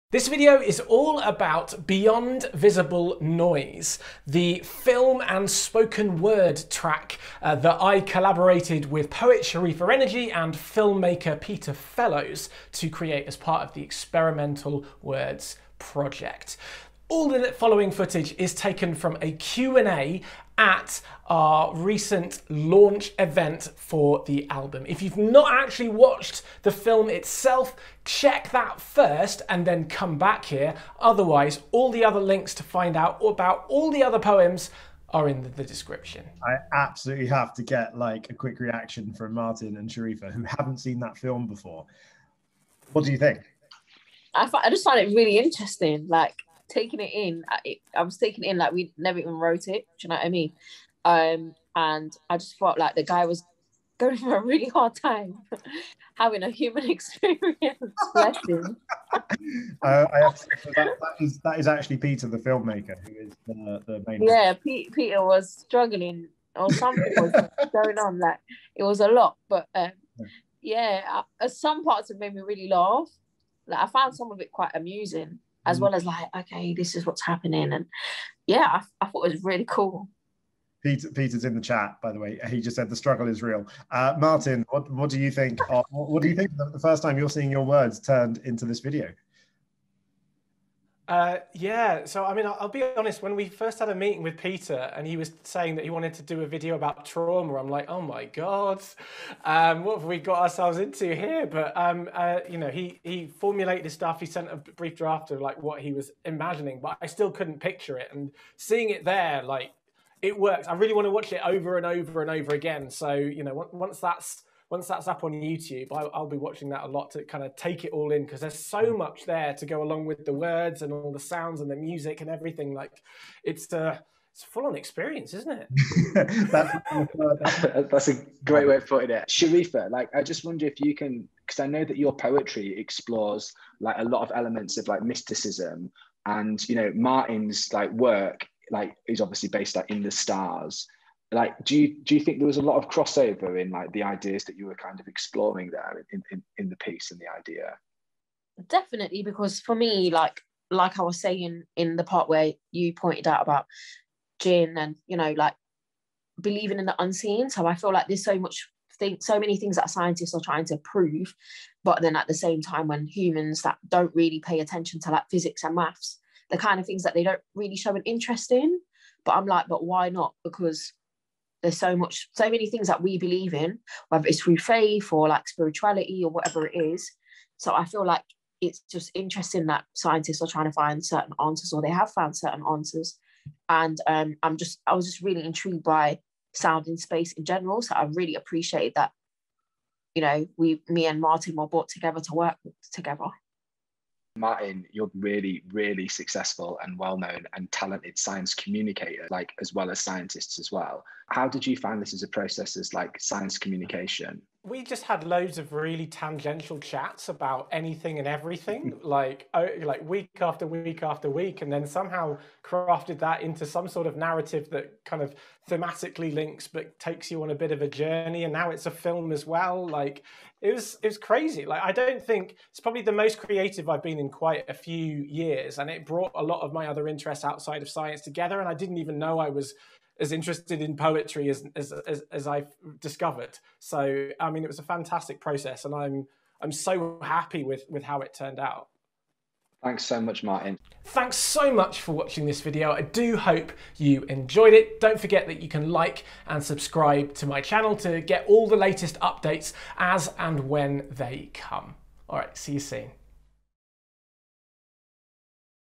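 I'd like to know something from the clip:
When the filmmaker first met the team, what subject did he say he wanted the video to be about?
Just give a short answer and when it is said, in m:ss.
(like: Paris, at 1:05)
Trauma, at 1:37.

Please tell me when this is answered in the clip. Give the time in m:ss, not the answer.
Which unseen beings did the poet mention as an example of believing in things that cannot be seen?
2:34.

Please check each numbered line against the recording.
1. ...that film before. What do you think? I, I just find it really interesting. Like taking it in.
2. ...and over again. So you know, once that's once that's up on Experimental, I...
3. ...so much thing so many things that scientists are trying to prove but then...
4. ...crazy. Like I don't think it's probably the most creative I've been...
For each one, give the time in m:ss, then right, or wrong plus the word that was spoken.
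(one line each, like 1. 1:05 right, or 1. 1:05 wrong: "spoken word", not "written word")
1. 0:41 right
2. 1:52 wrong: "YouTube", not "Experimental"
3. 2:38 right
4. 3:41 right.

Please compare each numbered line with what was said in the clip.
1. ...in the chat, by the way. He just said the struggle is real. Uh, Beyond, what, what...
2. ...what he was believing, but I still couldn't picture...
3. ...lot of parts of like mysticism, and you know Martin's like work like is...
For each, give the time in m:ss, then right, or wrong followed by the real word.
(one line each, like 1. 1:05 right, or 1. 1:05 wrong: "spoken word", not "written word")
1. 1:21 wrong: "Martin", not "Beyond"
2. 1:45 wrong: "imagining", not "believing"
3. 2:14 wrong: "elements", not "parts".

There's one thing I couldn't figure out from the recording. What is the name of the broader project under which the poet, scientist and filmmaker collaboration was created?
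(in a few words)
Experimental Words.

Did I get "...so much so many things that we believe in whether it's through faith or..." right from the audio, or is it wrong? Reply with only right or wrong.
right.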